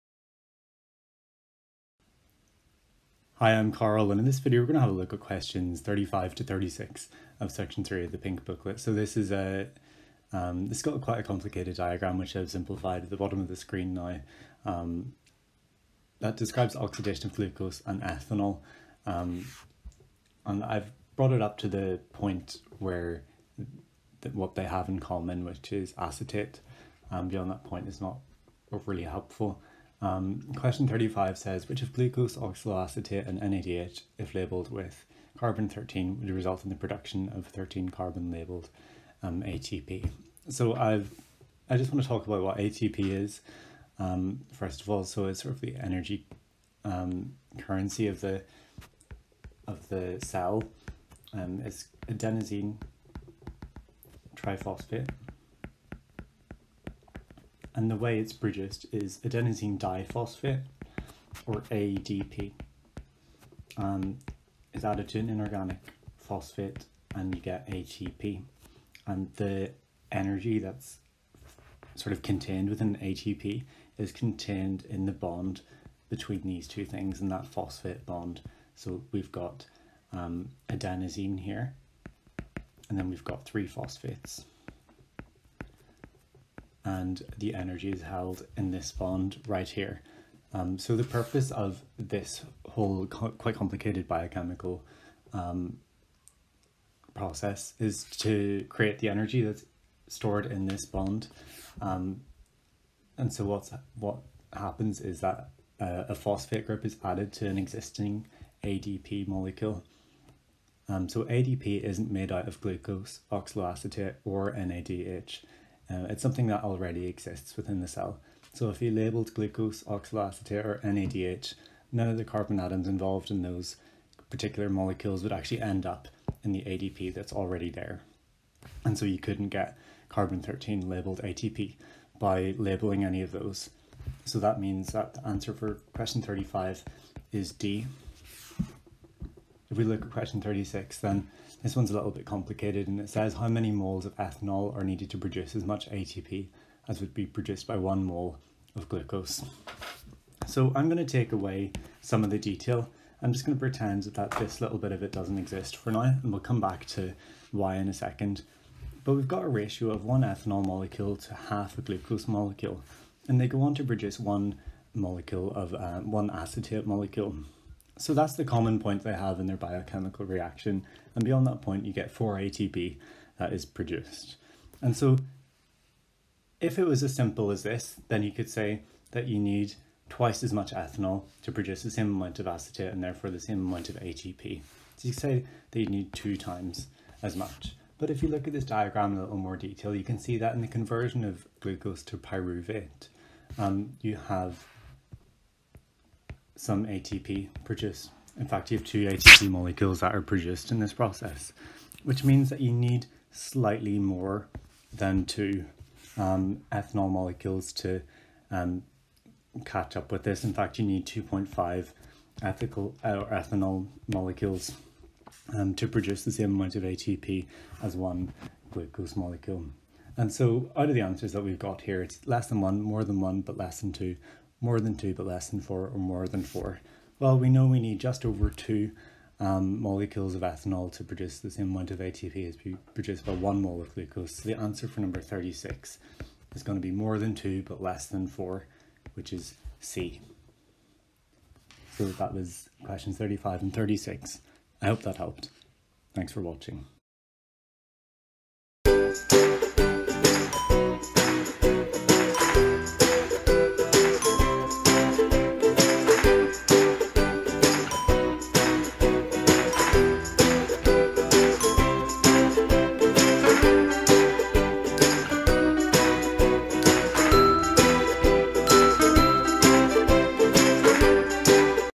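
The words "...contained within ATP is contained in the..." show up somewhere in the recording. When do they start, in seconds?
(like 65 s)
72 s.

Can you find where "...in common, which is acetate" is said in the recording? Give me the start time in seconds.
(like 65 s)
24 s.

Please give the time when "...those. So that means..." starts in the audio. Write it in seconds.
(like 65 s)
133 s.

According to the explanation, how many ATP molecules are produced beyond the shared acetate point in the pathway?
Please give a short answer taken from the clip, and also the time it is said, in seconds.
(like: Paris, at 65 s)
4, at 172 s.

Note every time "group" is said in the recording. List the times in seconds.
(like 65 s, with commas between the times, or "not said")
106 s.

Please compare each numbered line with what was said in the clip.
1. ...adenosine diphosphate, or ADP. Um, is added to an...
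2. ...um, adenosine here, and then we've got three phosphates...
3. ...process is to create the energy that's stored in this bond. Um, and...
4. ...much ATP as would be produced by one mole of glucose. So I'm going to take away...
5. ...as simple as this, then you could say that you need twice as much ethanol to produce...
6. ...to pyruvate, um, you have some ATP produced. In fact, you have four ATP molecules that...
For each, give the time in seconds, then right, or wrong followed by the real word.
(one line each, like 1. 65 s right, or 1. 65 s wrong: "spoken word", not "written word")
1. 59 s right
2. 80 s right
3. 97 s right
4. 145 s right
5. 177 s right
6. 192 s wrong: "two", not "four".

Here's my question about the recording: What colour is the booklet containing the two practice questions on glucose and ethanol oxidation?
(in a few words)
pink.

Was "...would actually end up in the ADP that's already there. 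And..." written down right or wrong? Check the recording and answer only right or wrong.
right.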